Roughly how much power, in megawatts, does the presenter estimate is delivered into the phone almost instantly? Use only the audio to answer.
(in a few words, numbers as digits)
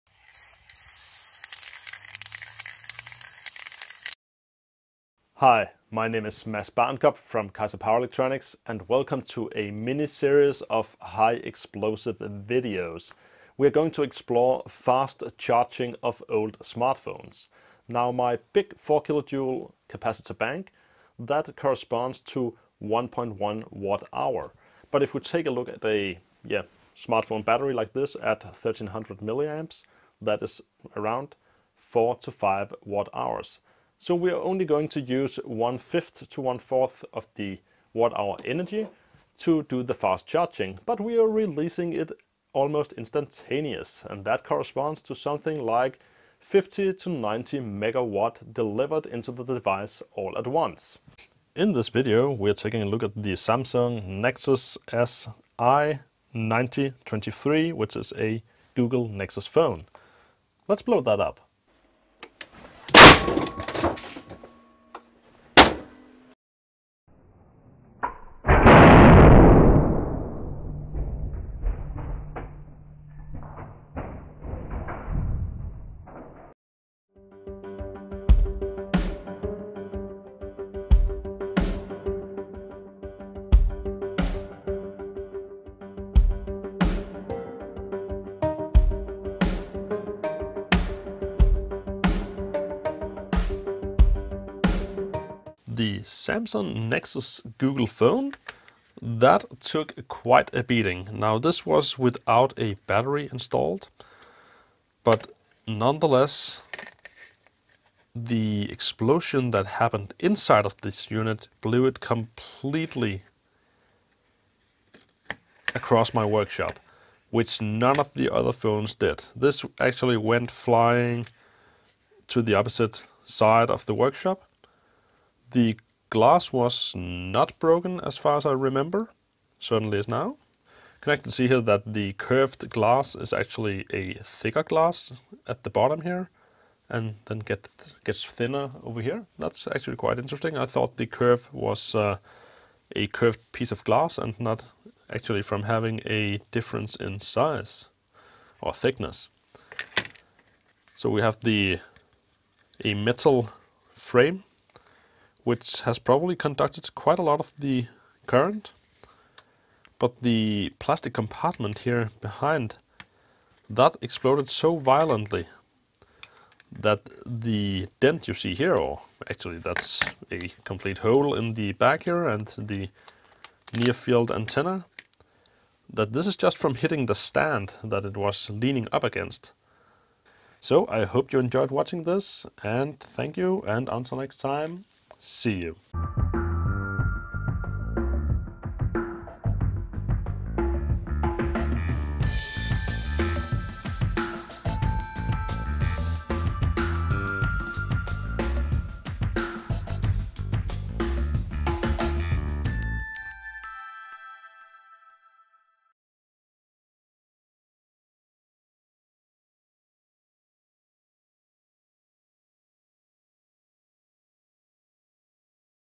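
50 to 90 megawatts.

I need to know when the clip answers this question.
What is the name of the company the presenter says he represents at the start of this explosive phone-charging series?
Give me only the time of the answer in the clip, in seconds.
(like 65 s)
7 s.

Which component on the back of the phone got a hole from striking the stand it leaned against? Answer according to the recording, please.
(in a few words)
near field antenna.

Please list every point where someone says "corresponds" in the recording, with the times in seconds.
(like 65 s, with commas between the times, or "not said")
21 s, 44 s.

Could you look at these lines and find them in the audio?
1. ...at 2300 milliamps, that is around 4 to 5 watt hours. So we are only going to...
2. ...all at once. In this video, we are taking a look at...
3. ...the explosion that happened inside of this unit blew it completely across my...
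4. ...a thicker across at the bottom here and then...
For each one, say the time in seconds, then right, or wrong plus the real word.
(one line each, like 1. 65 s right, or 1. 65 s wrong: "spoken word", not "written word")
1. 28 s wrong: "1300", not "2300"
2. 50 s right
3. 108 s right
4. 133 s wrong: "glass", not "across".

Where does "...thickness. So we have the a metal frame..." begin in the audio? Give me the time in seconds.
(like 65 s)
148 s.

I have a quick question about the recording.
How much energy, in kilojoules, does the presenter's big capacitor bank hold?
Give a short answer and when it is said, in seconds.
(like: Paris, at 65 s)
4 kilojoules, at 18 s.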